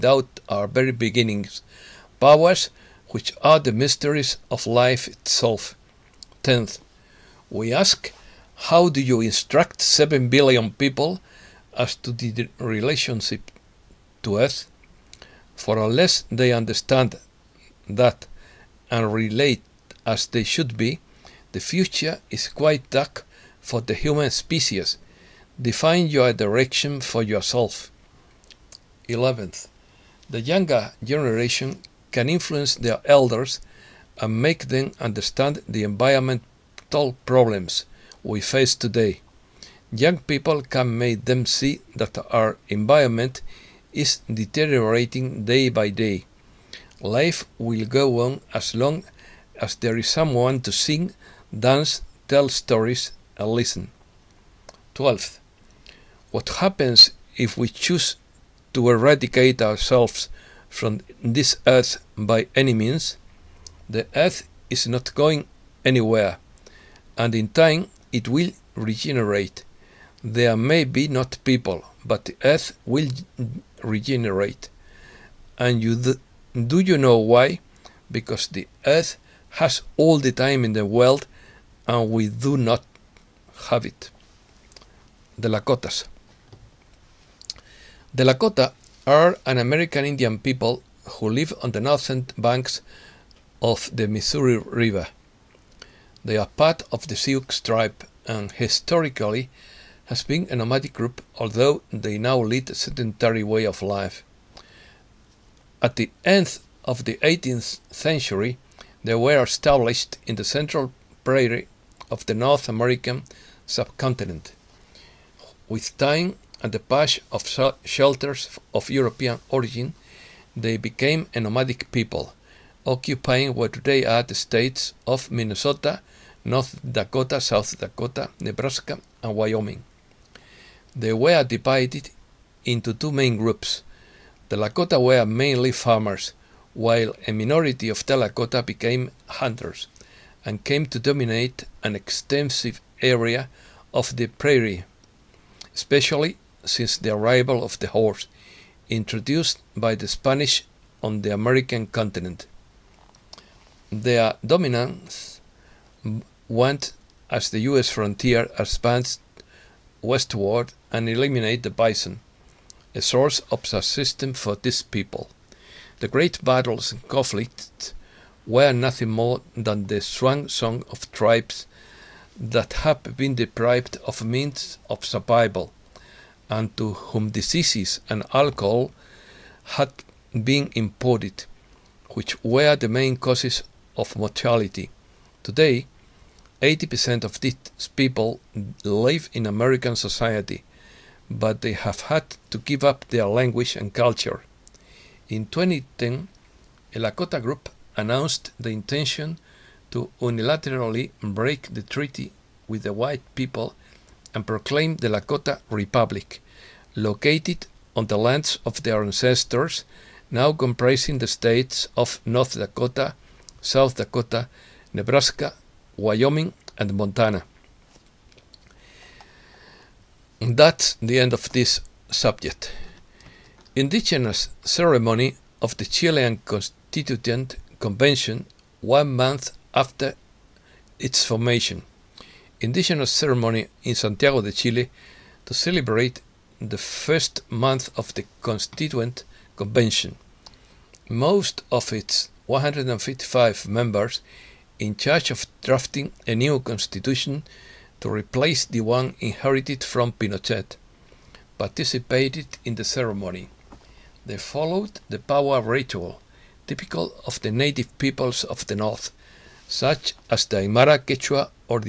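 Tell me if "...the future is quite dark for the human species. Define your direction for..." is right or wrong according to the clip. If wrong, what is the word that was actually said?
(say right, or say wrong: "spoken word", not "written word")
right.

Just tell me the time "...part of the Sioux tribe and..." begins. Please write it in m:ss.
1:36.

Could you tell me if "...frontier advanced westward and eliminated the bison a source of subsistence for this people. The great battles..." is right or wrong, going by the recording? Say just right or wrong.
right.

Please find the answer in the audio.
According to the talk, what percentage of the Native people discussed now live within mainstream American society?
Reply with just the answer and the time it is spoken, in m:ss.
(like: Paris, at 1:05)
80%, at 3:06.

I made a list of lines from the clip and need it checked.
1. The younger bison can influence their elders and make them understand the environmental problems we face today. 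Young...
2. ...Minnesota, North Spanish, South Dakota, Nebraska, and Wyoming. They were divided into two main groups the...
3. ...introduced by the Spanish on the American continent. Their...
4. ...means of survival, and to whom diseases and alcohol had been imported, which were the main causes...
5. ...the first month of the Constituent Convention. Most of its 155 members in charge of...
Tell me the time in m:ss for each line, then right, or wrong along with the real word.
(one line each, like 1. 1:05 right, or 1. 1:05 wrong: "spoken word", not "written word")
1. 0:30 wrong: "generation", not "bison"
2. 2:05 wrong: "Dakota", not "Spanish"
3. 2:28 right
4. 2:54 right
5. 3:56 right.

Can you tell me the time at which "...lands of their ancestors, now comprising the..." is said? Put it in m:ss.
3:28.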